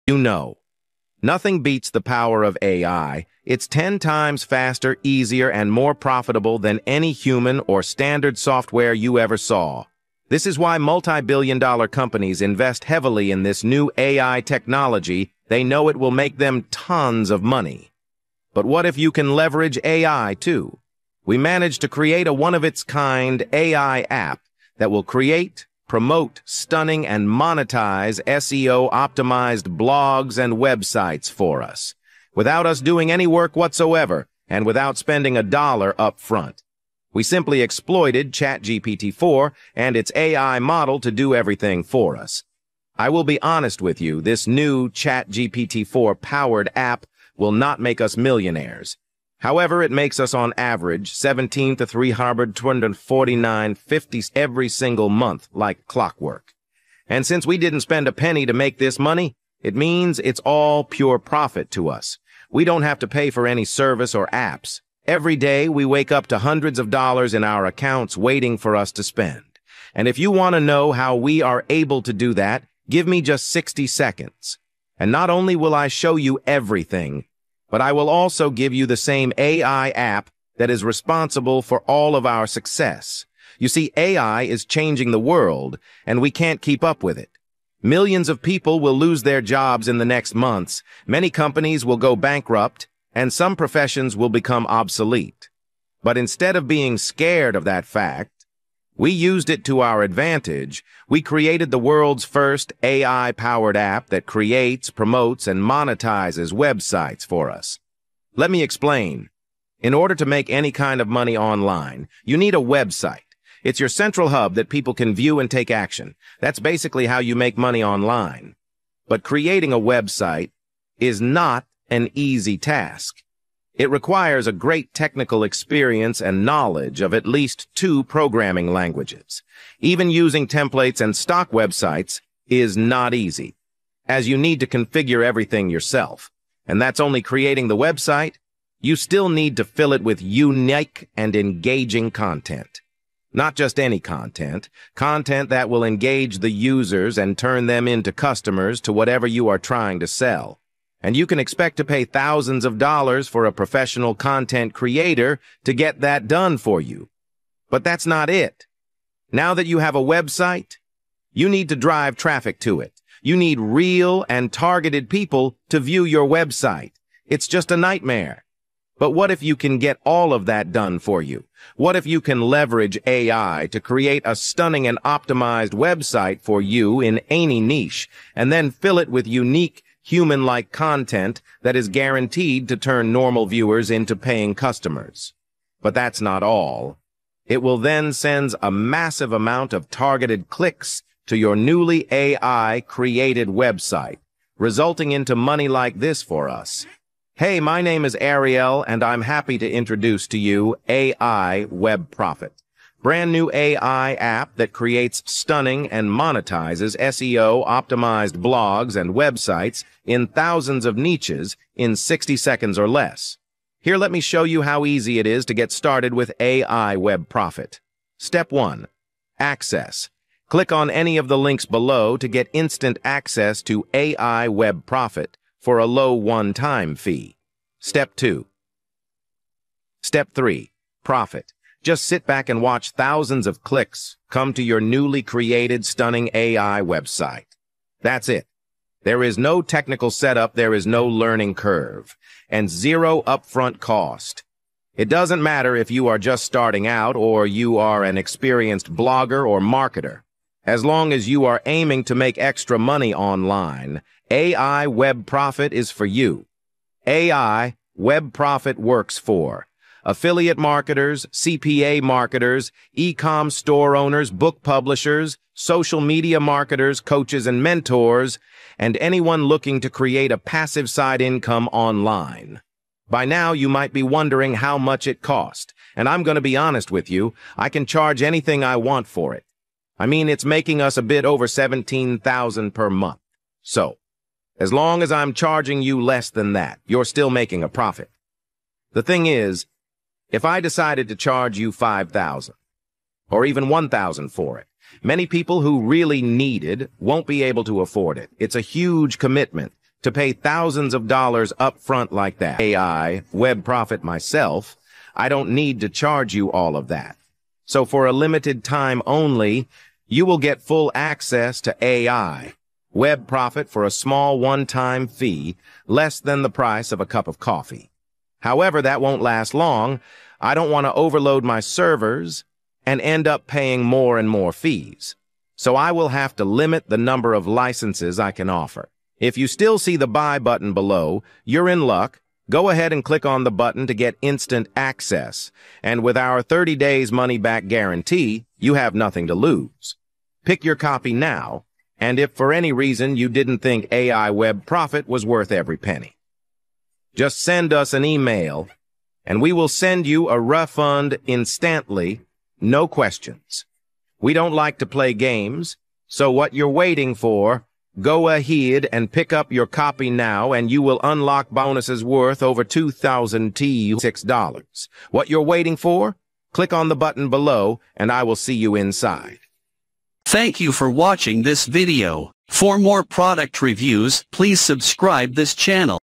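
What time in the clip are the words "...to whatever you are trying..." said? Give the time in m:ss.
2:28.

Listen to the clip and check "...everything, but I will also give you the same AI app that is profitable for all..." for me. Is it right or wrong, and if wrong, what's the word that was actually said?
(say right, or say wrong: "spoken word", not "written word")
wrong: "responsible", not "profitable".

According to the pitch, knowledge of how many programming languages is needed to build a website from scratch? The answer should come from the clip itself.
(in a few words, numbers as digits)
2.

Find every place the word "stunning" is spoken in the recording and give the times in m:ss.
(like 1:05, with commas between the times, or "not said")
0:26, 2:54, 3:25, 3:55.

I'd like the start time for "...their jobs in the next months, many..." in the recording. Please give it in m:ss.
1:29.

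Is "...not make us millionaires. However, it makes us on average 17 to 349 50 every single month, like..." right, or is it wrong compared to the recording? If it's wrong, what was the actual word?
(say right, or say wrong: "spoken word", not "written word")
right.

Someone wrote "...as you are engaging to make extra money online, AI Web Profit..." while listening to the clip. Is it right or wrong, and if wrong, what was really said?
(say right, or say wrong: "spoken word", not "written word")
wrong: "aiming", not "engaging".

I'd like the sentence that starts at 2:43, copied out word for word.
You need real and targeted people to view your website.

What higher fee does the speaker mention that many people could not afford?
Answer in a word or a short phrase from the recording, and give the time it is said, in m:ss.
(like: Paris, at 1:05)
5,000, at 4:51.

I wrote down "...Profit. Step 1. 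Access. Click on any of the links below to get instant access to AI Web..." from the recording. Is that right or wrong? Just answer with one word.
right.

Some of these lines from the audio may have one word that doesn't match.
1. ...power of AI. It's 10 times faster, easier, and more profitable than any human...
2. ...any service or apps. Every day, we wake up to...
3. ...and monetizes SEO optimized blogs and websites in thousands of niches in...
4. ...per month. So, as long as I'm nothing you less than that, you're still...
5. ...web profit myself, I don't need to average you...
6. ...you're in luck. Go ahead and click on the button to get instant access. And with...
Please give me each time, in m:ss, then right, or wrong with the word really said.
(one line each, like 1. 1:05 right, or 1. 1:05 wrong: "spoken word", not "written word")
1. 0:02 right
2. 1:03 right
3. 3:25 right
4. 4:42 wrong: "charging", not "nothing"
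5. 5:03 wrong: "charge", not "average"
6. 5:31 right.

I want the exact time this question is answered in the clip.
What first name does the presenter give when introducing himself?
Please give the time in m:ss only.
3:18.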